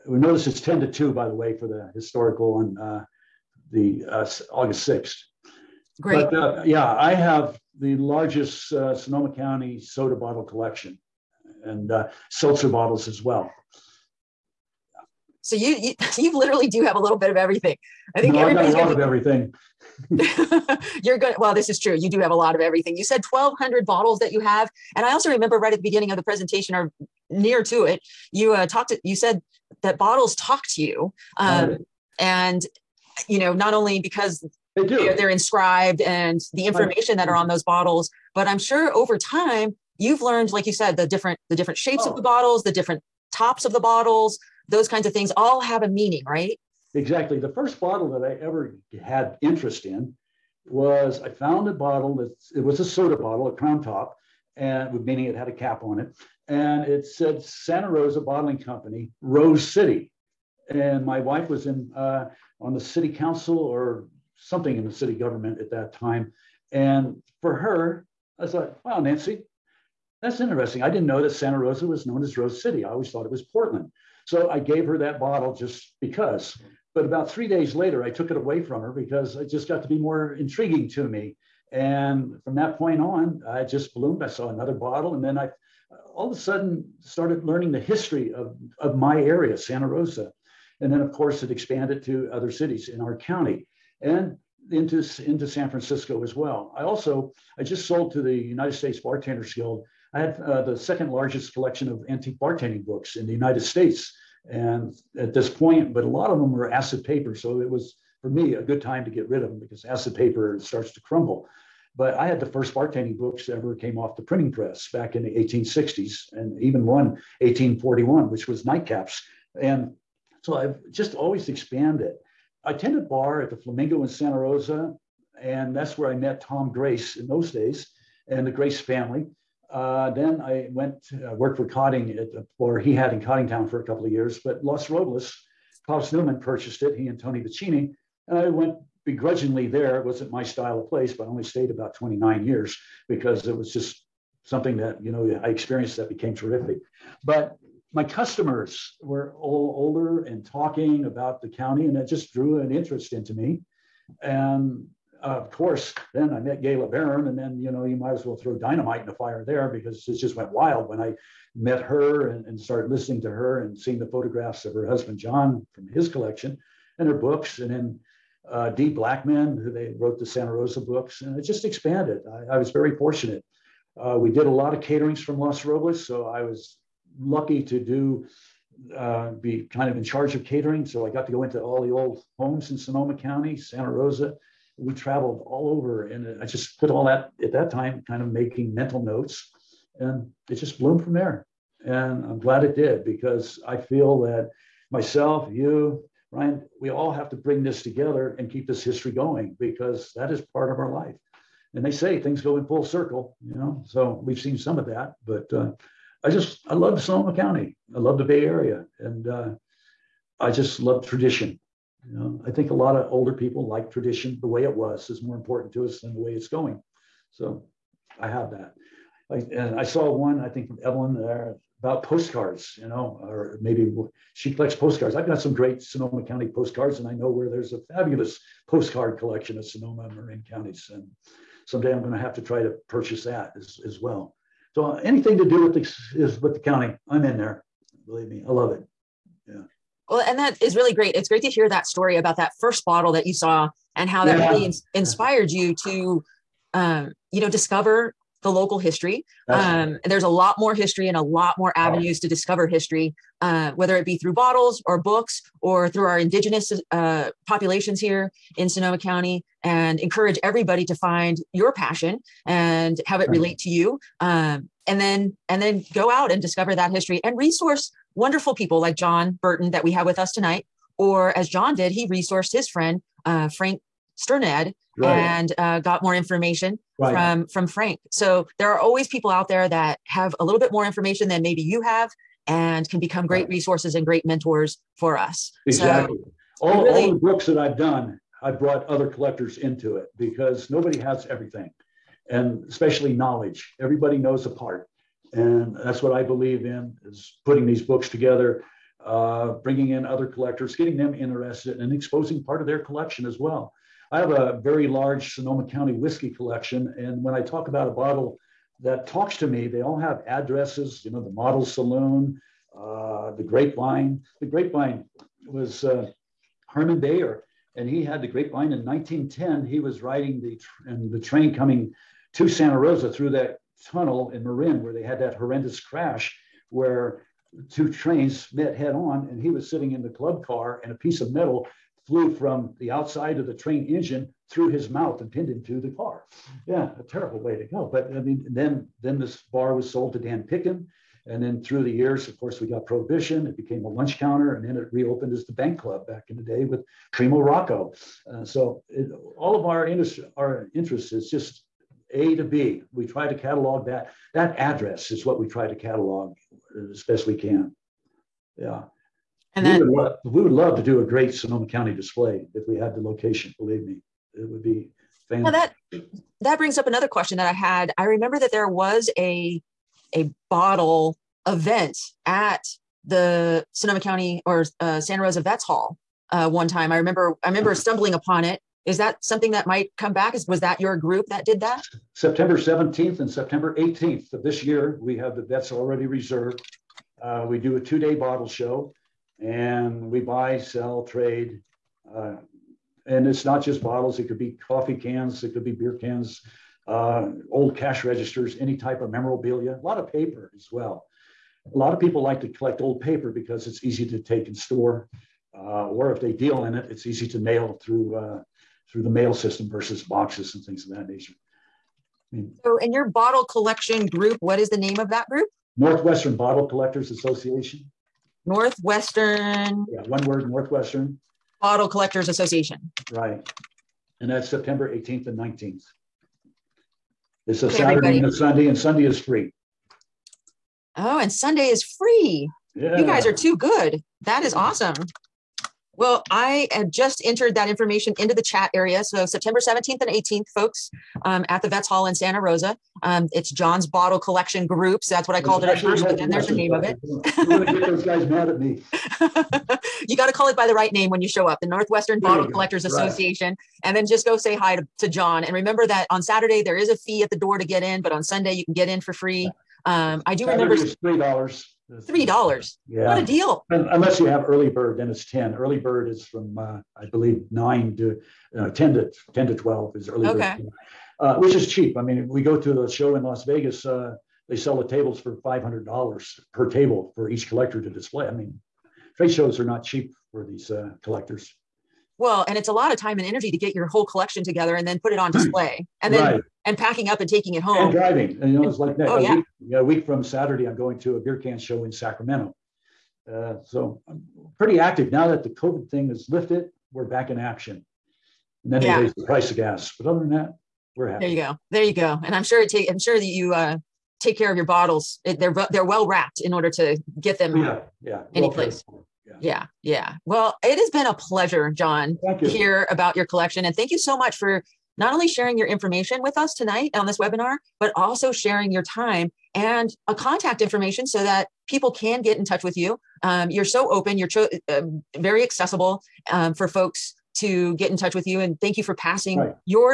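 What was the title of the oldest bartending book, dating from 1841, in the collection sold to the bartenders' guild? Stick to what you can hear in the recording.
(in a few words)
Nightcaps.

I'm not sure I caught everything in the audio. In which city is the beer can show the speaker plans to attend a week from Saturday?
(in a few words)
Sacramento.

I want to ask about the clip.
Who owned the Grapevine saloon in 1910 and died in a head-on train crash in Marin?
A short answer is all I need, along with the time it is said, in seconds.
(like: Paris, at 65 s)
Herman Bayer, at 316 s.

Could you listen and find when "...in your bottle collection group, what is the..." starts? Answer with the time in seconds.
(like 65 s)
412 s.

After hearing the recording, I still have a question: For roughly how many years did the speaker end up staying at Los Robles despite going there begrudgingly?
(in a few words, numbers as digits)
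29 years.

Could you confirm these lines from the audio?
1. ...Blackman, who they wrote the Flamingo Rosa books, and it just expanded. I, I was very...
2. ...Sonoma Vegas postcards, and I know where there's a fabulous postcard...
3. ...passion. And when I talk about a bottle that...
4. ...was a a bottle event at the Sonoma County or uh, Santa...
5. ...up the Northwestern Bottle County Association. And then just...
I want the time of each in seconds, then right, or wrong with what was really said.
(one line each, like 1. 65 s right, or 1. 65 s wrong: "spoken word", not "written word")
1. 168 s wrong: "Santa", not "Flamingo"
2. 225 s wrong: "County", not "Vegas"
3. 306 s wrong: "collection", not "passion"
4. 368 s right
5. 451 s wrong: "Collectors", not "County".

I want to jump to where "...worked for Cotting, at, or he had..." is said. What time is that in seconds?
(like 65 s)
131 s.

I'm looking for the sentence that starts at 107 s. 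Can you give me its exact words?
So it was, for me, a good time to get rid of them because acid paper starts to crumble.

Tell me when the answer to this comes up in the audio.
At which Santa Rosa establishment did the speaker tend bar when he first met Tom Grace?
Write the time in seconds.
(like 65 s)
123 s.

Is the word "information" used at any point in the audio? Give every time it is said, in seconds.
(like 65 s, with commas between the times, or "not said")
36 s, 276 s, 280 s, 437 s, 515 s, 520 s.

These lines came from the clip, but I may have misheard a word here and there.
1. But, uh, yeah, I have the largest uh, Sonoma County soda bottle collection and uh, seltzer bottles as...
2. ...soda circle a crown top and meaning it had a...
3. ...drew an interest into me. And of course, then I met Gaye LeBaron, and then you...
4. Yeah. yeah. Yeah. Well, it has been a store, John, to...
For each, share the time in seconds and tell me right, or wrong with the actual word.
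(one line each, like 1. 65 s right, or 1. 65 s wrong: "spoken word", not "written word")
1. 6 s right
2. 52 s wrong: "bottle", not "circle"
3. 152 s right
4. 509 s wrong: "pleasure", not "store".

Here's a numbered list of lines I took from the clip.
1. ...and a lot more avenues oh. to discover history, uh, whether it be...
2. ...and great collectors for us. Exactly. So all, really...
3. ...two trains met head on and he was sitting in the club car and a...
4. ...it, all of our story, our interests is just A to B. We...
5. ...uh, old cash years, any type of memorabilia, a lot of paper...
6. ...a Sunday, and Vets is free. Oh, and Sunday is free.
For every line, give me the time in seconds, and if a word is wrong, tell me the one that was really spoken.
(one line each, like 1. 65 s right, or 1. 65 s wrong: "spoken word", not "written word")
1. 251 s right
2. 283 s wrong: "mentors", not "collectors"
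3. 327 s right
4. 348 s wrong: "industry", not "story"
5. 396 s wrong: "registers", not "years"
6. 428 s wrong: "Sunday", not "Vets".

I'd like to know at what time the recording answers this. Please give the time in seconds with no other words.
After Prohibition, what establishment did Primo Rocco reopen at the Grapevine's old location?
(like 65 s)
345 s.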